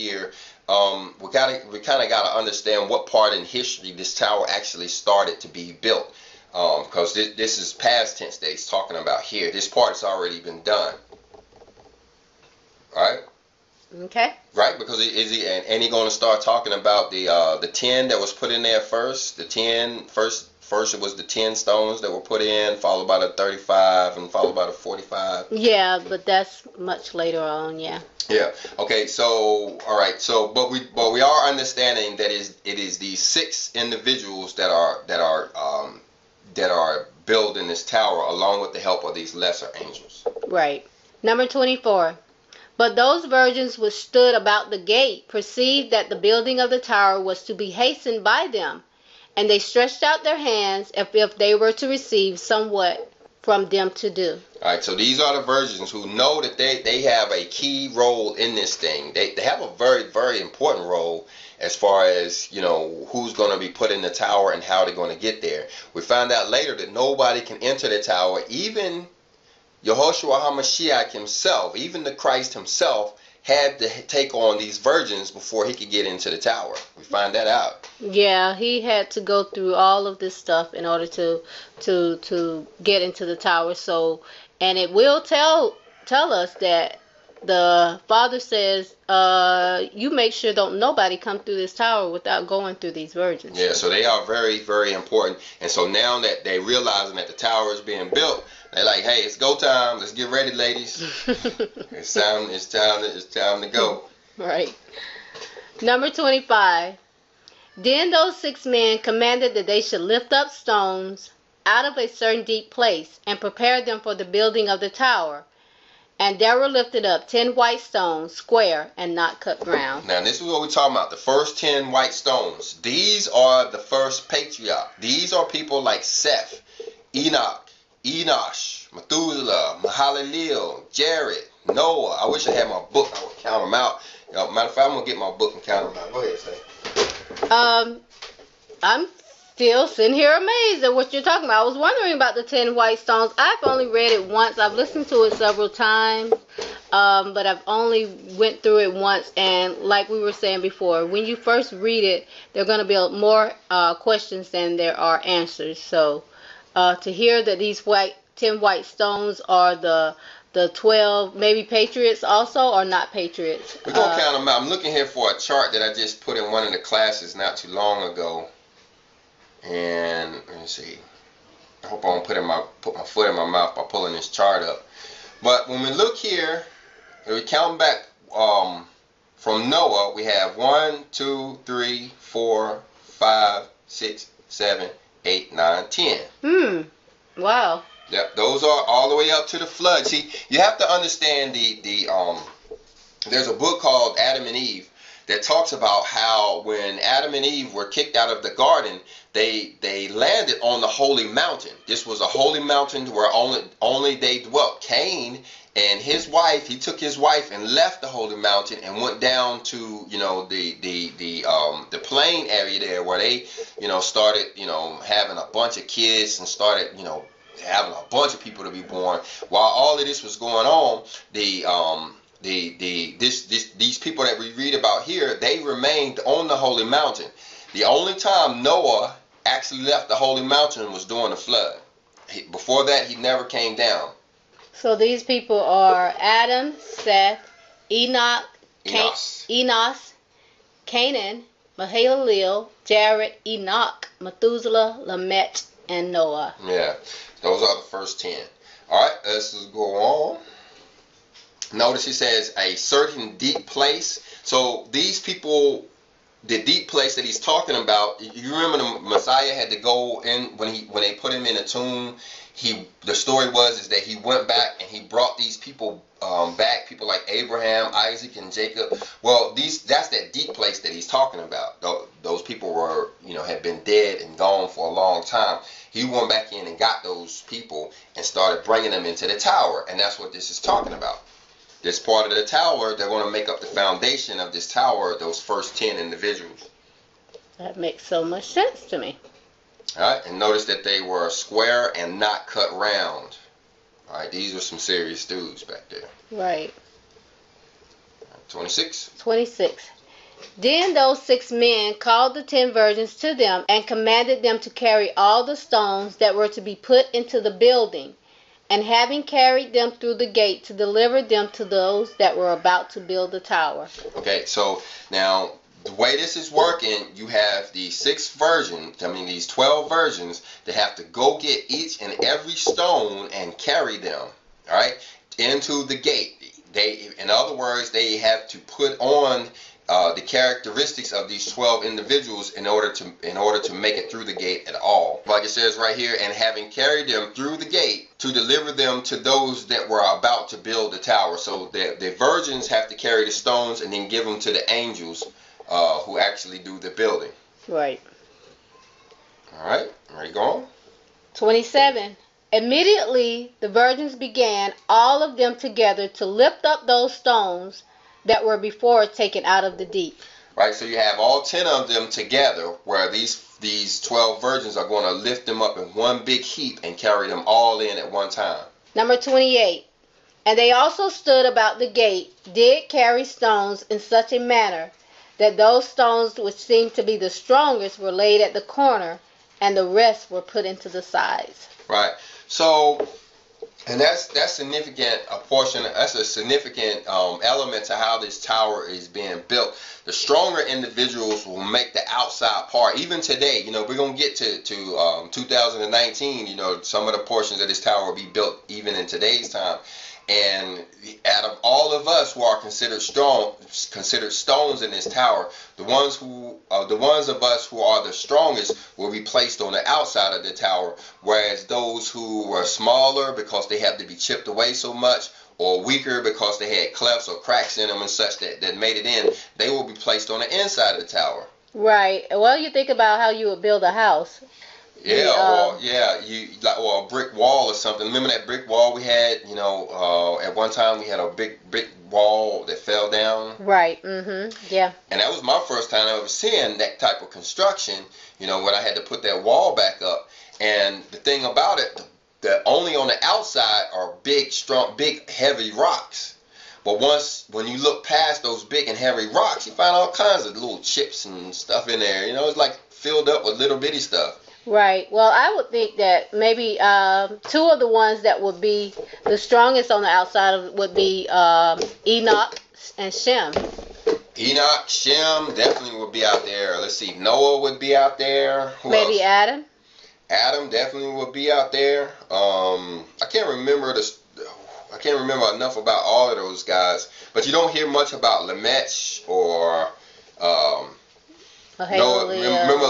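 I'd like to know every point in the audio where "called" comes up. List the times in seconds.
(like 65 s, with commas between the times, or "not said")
193 s, 301 s.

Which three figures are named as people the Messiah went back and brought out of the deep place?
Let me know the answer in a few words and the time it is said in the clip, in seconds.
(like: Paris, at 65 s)
Abraham, Isaac, and Jacob, at 267 s.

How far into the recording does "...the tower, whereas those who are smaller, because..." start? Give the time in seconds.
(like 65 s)
410 s.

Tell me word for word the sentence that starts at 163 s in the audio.
We're gonna uh, count them out.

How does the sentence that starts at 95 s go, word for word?
And so now that they realizing that the tower is being built, they're like, hey, it's go time.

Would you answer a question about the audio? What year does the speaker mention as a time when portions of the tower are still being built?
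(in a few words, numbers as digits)
2019.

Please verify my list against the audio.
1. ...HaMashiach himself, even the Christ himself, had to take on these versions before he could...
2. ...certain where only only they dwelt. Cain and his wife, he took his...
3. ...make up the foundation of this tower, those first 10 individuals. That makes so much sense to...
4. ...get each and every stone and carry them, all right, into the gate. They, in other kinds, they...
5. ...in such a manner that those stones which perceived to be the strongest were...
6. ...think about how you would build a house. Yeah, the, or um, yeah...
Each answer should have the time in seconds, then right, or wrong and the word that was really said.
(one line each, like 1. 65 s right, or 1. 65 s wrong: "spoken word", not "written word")
1. 70 s wrong: "virgins", not "versions"
2. 202 s wrong: "mountain", not "certain"
3. 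283 s right
4. 321 s wrong: "words", not "kinds"
5. 373 s wrong: "seemed", not "perceived"
6. 422 s right.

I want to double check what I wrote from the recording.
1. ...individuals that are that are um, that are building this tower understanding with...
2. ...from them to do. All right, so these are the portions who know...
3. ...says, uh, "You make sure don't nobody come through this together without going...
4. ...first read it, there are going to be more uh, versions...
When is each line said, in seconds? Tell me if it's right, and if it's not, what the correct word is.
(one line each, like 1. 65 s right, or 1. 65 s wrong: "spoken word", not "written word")
1. 33 s wrong: "along", not "understanding"
2. 53 s wrong: "virgins", not "portions"
3. 88 s wrong: "tower", not "together"
4. 151 s wrong: "questions", not "versions".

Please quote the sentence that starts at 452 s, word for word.
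You know, it's like filled up with little bitty stuff.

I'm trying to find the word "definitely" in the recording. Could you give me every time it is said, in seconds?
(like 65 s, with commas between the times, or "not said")
465 s, 470 s.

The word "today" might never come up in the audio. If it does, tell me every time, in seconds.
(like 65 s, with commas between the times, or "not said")
393 s, 399 s.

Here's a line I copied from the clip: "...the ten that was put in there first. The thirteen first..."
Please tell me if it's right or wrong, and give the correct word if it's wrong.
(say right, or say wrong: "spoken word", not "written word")
wrong: "ten", not "thirteen".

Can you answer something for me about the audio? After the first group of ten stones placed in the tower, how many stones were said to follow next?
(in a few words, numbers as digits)
35.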